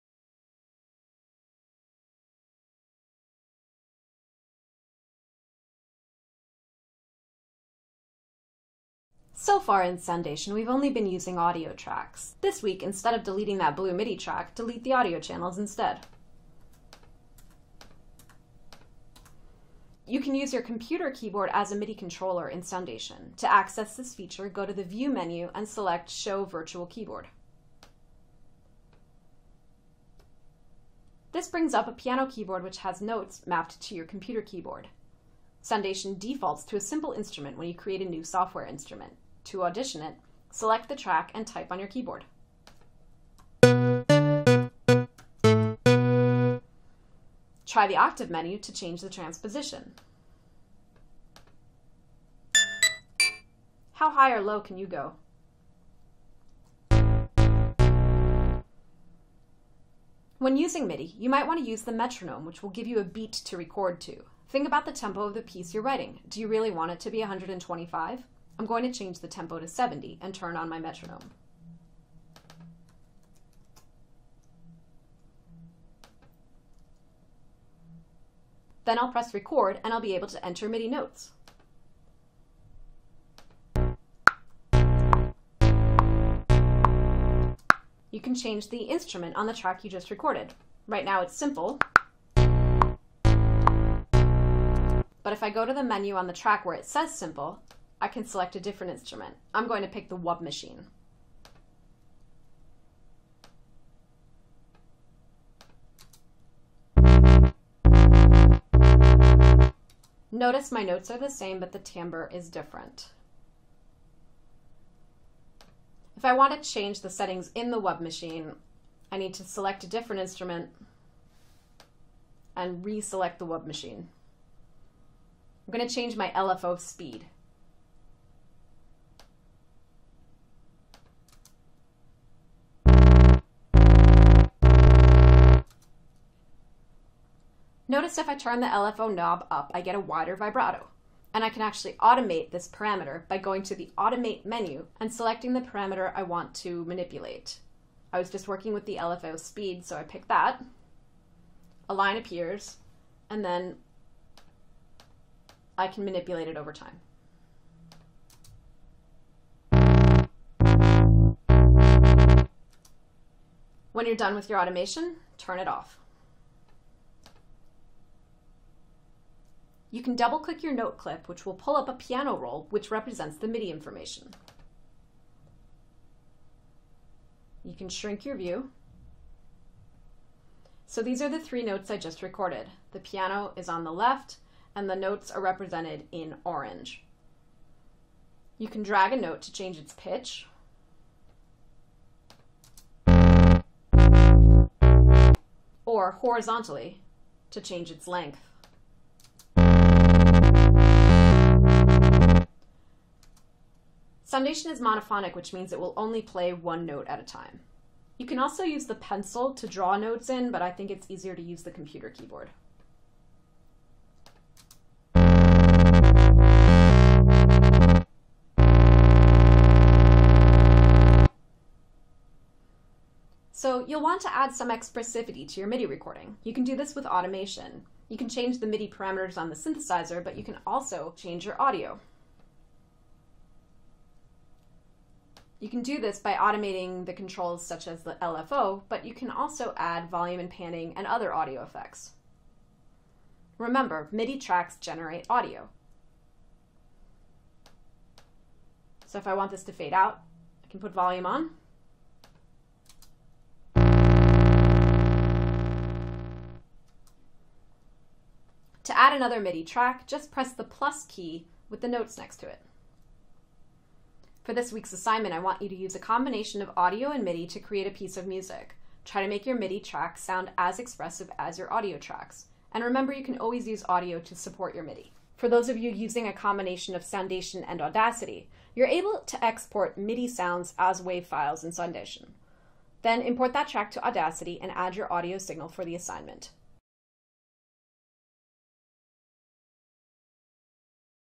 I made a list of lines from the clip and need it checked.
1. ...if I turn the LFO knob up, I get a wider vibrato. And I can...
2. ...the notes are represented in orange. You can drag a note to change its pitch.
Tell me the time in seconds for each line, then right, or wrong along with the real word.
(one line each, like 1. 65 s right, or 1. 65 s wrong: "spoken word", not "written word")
1. 138 s right
2. 184 s right.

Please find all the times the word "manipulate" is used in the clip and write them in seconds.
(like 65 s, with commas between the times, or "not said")
146 s, 156 s.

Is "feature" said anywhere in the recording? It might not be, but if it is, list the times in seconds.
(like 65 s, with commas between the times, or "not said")
24 s.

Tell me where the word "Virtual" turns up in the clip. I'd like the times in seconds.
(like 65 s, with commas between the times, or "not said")
26 s.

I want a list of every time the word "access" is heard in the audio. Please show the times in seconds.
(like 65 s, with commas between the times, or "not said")
23 s.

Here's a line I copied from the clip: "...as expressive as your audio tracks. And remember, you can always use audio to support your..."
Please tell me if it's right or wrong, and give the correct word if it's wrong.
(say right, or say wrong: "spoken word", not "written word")
right.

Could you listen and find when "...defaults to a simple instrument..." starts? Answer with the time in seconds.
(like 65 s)
36 s.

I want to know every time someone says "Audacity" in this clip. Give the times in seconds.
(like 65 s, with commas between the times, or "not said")
277 s, 284 s.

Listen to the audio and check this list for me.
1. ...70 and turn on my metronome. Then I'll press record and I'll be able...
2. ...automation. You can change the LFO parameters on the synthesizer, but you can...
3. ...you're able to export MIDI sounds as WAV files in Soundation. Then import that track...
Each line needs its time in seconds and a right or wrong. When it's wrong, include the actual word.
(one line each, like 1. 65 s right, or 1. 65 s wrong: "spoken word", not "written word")
1. 69 s right
2. 227 s wrong: "MIDI", not "LFO"
3. 278 s right.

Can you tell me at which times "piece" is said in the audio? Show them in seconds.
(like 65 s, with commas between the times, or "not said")
65 s, 267 s.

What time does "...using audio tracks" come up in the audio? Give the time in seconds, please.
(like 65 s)
11 s.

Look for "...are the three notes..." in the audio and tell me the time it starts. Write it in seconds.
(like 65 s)
181 s.